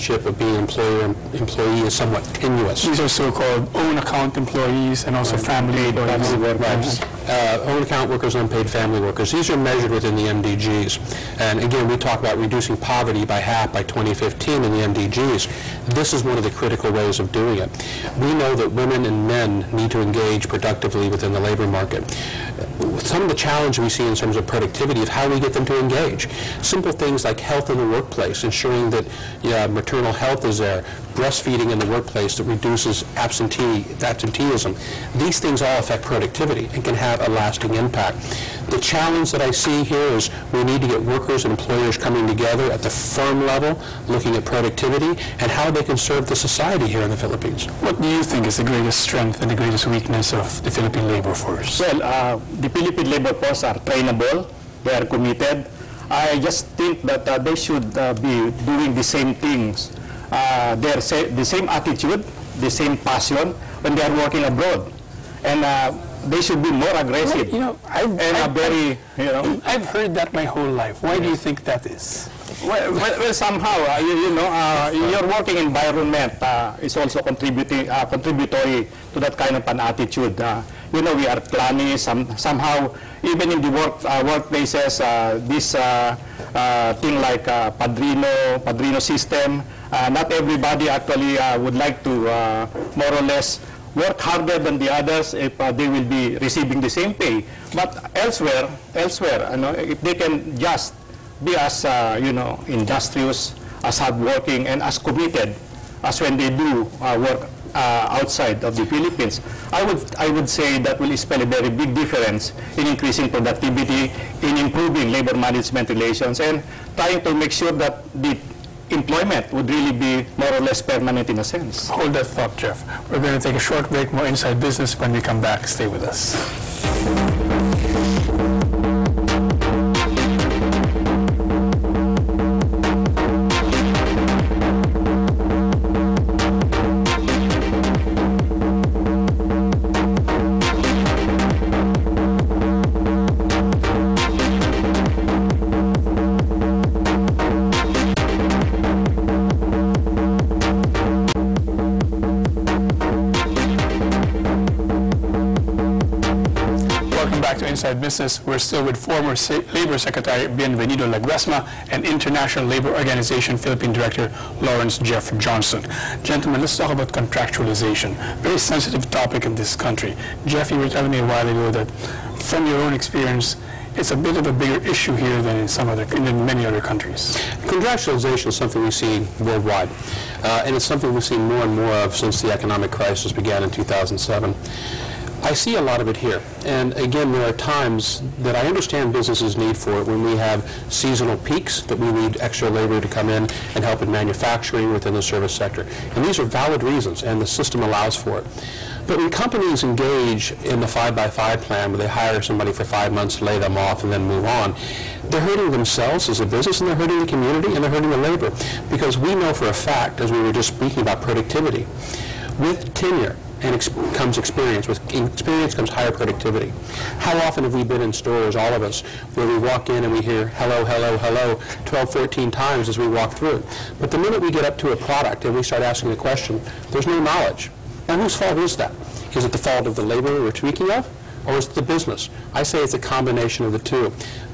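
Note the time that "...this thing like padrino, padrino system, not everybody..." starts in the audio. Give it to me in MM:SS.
01:25.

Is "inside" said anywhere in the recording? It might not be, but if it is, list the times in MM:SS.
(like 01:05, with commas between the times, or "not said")
02:04, 02:37.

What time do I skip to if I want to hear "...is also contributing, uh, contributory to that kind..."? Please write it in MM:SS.
01:16.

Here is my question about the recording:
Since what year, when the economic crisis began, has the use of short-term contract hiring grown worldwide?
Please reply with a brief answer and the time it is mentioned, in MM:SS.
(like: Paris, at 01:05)
2007, at 03:03.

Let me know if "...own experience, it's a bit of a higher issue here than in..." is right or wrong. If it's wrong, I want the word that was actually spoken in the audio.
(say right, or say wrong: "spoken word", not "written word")
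wrong: "bigger", not "higher".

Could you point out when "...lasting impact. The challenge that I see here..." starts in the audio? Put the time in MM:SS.
00:37.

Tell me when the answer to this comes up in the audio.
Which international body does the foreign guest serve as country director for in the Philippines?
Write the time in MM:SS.
02:42.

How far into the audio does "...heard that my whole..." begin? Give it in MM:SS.
01:09.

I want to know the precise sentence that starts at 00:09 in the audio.
These are measured within the MDGs.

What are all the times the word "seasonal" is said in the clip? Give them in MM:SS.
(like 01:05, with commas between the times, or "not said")
03:10.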